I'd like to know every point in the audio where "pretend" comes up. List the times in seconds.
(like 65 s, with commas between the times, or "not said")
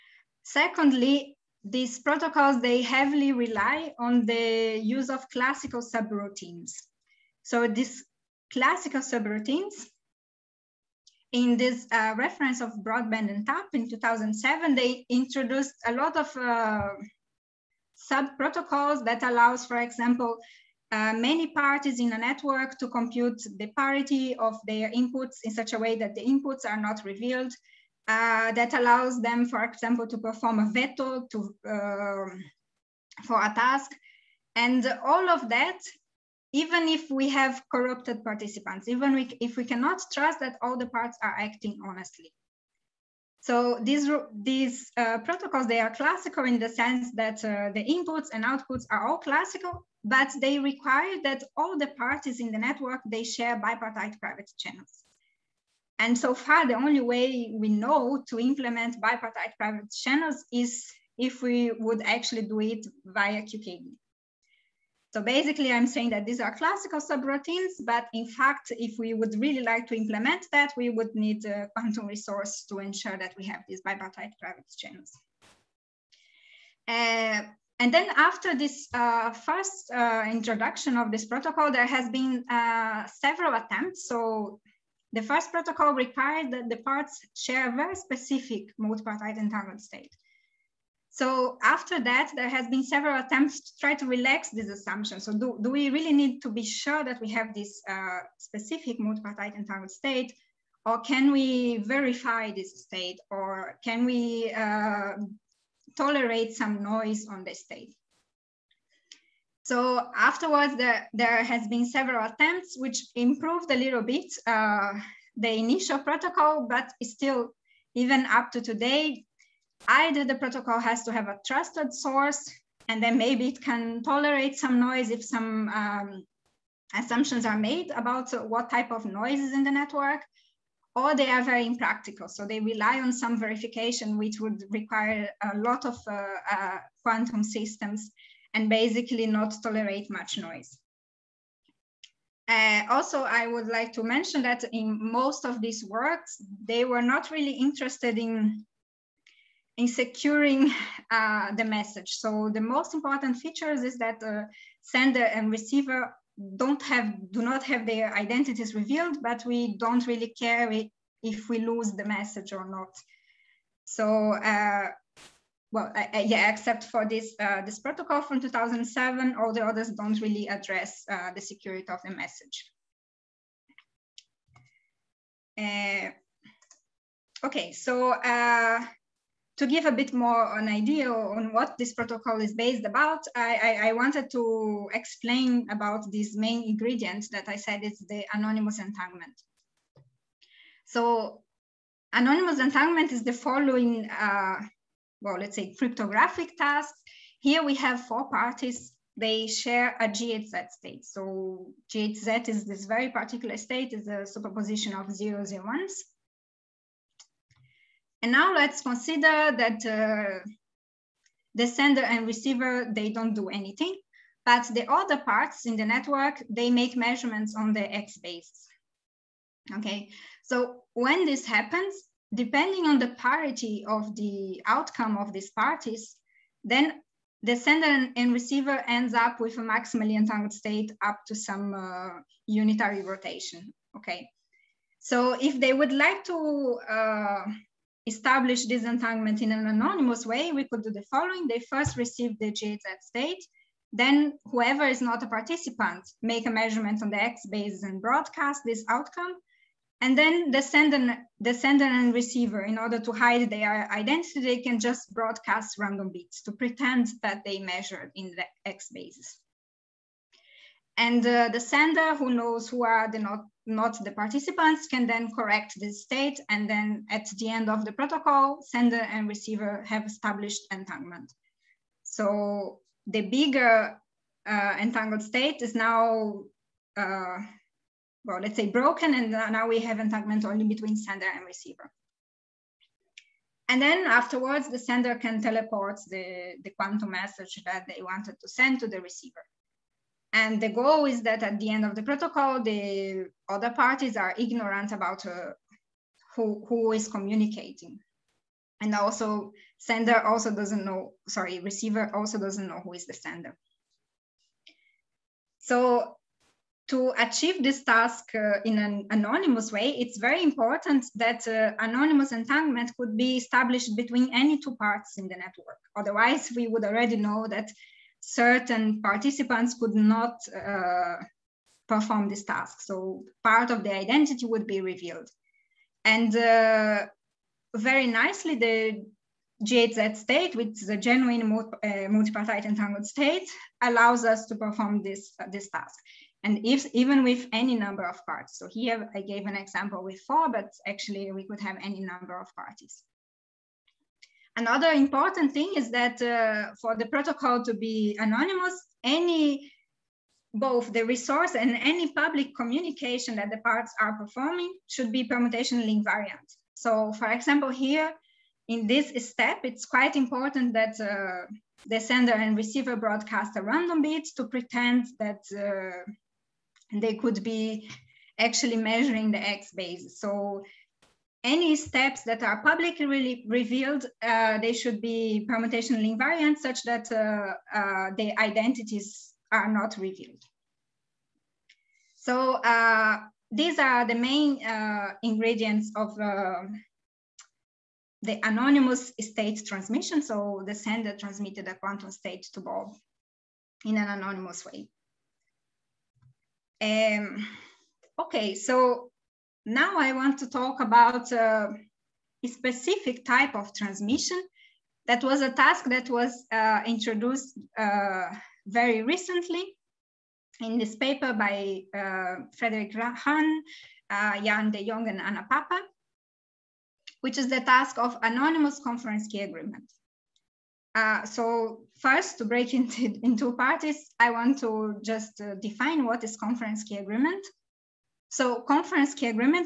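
256 s, 364 s.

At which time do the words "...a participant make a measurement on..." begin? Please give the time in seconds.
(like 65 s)
245 s.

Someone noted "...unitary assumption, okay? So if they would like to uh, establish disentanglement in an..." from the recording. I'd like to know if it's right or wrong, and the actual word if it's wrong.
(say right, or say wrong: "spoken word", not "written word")
wrong: "rotation", not "assumption".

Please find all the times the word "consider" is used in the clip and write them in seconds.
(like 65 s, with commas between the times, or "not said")
208 s.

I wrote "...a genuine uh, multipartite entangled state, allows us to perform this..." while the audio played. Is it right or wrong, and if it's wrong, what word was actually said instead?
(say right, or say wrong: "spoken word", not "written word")
right.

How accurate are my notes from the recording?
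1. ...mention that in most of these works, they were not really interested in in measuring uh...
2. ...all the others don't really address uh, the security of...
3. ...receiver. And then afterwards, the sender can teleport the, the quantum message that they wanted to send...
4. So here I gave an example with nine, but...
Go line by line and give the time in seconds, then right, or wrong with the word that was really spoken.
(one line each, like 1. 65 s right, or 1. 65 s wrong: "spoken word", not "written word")
1. 144 s wrong: "securing", not "measuring"
2. 169 s right
3. 281 s right
4. 338 s wrong: "four", not "nine".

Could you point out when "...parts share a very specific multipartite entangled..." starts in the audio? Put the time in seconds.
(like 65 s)
86 s.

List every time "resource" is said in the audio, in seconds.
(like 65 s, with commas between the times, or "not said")
72 s, 351 s.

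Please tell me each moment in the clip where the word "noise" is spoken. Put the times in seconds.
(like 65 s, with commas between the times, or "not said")
106 s, 124 s, 129 s, 140 s.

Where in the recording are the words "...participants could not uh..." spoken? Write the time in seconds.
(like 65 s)
319 s.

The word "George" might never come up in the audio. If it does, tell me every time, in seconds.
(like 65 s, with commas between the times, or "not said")
not said.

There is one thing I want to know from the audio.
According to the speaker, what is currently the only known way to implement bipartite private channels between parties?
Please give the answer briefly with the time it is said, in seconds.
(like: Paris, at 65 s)
QKD, at 63 s.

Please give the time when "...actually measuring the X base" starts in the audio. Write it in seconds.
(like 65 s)
368 s.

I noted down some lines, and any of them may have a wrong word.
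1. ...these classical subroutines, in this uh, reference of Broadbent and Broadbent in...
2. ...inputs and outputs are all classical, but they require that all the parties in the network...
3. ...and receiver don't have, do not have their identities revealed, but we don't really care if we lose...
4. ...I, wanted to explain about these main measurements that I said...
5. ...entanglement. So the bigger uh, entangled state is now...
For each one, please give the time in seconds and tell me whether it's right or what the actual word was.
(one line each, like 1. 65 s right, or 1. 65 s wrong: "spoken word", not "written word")
1. 7 s wrong: "Tapp", not "Broadbent"
2. 47 s right
3. 155 s right
4. 183 s wrong: "ingredients", not "measurements"
5. 270 s right.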